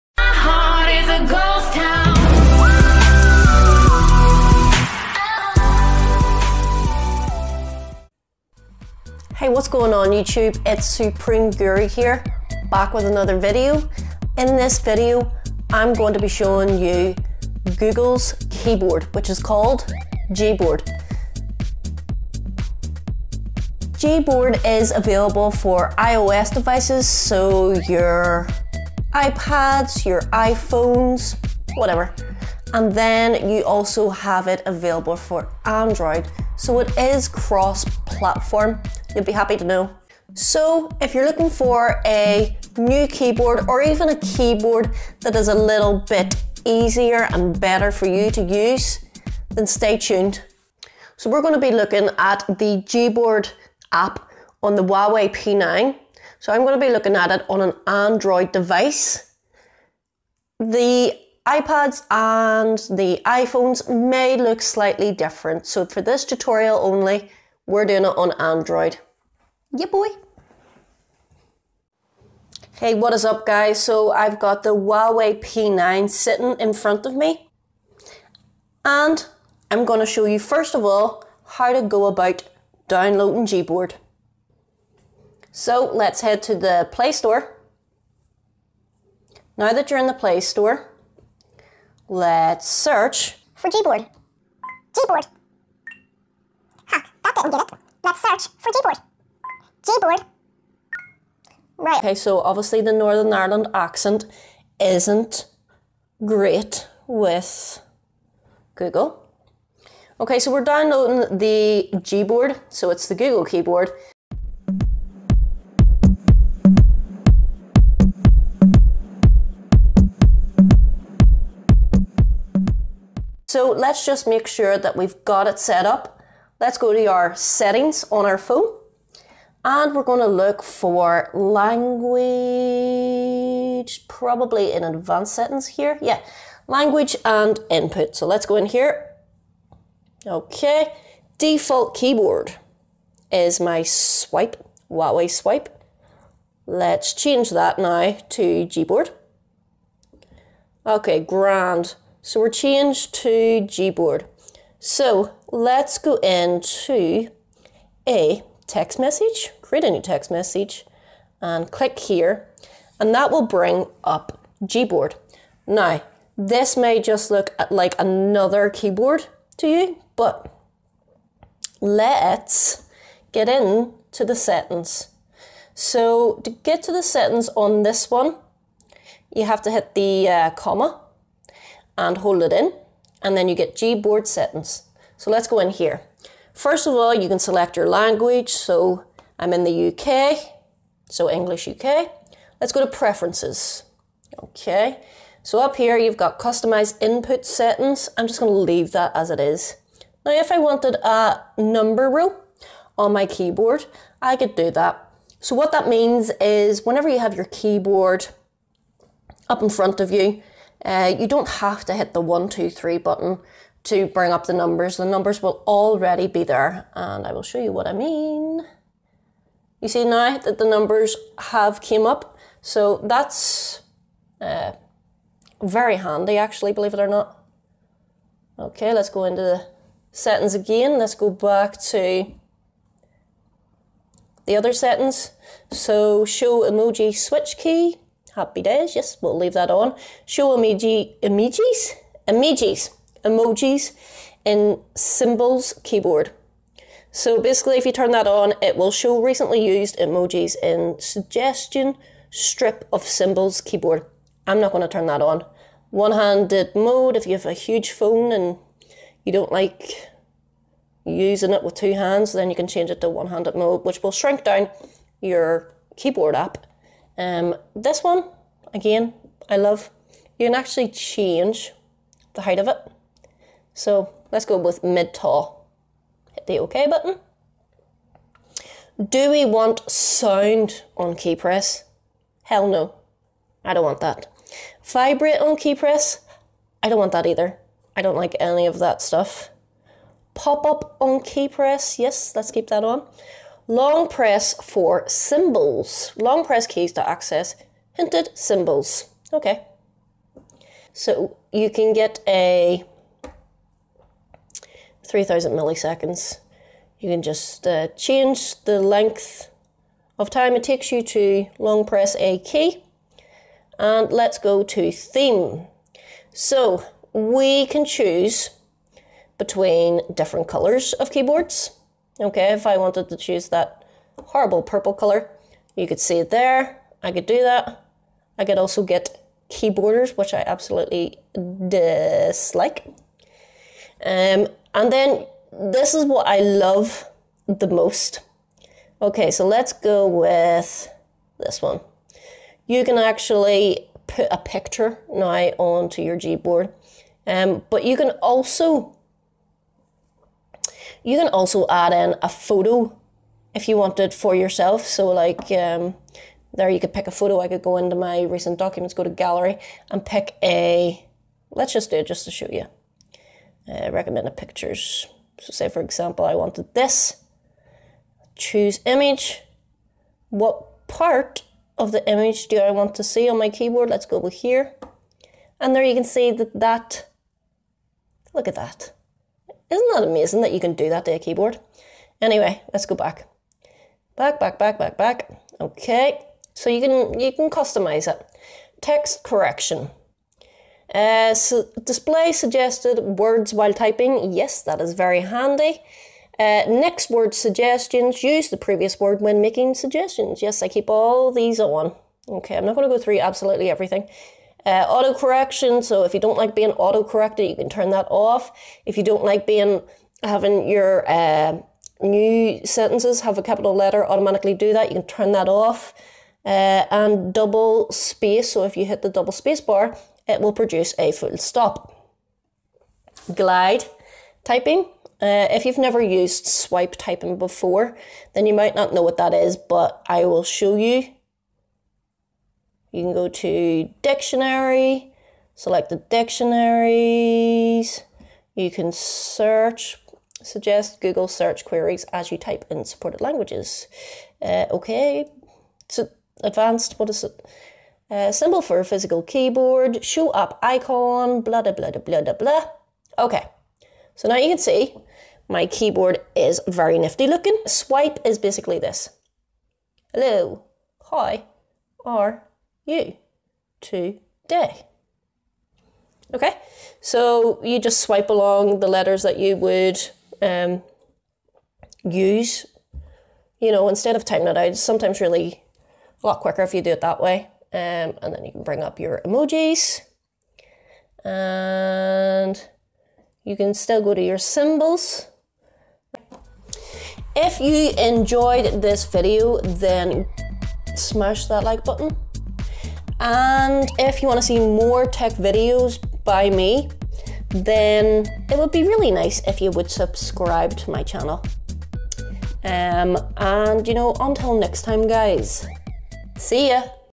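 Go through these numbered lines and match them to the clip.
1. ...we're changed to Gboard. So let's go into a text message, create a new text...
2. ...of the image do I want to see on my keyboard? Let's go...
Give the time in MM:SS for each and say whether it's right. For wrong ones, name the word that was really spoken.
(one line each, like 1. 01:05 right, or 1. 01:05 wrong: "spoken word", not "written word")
1. 02:32 right
2. 06:11 right.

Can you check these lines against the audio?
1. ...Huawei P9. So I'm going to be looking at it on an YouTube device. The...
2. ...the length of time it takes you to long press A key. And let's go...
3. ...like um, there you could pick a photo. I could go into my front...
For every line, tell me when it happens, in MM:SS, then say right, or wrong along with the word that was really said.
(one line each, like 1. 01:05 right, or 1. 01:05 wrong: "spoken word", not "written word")
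1. 00:54 wrong: "Android", not "YouTube"
2. 05:08 right
3. 05:55 wrong: "recent", not "front".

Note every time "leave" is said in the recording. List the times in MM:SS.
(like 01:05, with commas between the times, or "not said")
03:18, 03:59.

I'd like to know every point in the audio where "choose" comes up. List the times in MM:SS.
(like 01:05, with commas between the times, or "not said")
05:17, 05:23, 06:08.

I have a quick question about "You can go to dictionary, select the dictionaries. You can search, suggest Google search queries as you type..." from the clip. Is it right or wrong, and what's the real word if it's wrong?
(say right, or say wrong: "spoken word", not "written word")
right.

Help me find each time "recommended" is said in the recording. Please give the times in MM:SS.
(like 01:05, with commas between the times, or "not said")
06:03.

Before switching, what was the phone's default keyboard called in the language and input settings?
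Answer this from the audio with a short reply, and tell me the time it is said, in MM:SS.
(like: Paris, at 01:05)
Huawei swipe, at 02:24.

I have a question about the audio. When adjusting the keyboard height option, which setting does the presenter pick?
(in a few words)
mid tall.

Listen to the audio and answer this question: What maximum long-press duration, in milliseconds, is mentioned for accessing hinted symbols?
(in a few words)
3000.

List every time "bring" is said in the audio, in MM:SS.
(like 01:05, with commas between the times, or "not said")
02:43, 03:34, 07:58.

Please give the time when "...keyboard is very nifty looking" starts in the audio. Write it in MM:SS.
07:35.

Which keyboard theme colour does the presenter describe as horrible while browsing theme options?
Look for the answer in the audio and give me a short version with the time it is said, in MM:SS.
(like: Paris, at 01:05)
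purple, at 05:24.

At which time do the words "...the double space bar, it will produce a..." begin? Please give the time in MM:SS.
06:59.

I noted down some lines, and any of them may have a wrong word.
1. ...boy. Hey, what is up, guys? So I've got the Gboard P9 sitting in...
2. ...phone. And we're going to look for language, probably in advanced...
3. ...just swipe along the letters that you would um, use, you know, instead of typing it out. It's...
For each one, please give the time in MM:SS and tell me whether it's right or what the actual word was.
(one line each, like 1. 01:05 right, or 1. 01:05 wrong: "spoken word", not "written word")
1. 01:09 wrong: "Huawei", not "Gboard"
2. 02:08 right
3. 07:47 right.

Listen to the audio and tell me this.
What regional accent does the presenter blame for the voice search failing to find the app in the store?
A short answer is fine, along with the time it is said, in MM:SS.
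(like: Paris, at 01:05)
Northern Ireland, at 01:42.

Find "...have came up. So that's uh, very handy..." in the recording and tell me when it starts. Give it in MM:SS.
03:41.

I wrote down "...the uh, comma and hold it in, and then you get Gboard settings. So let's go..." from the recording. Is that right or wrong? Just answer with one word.
right.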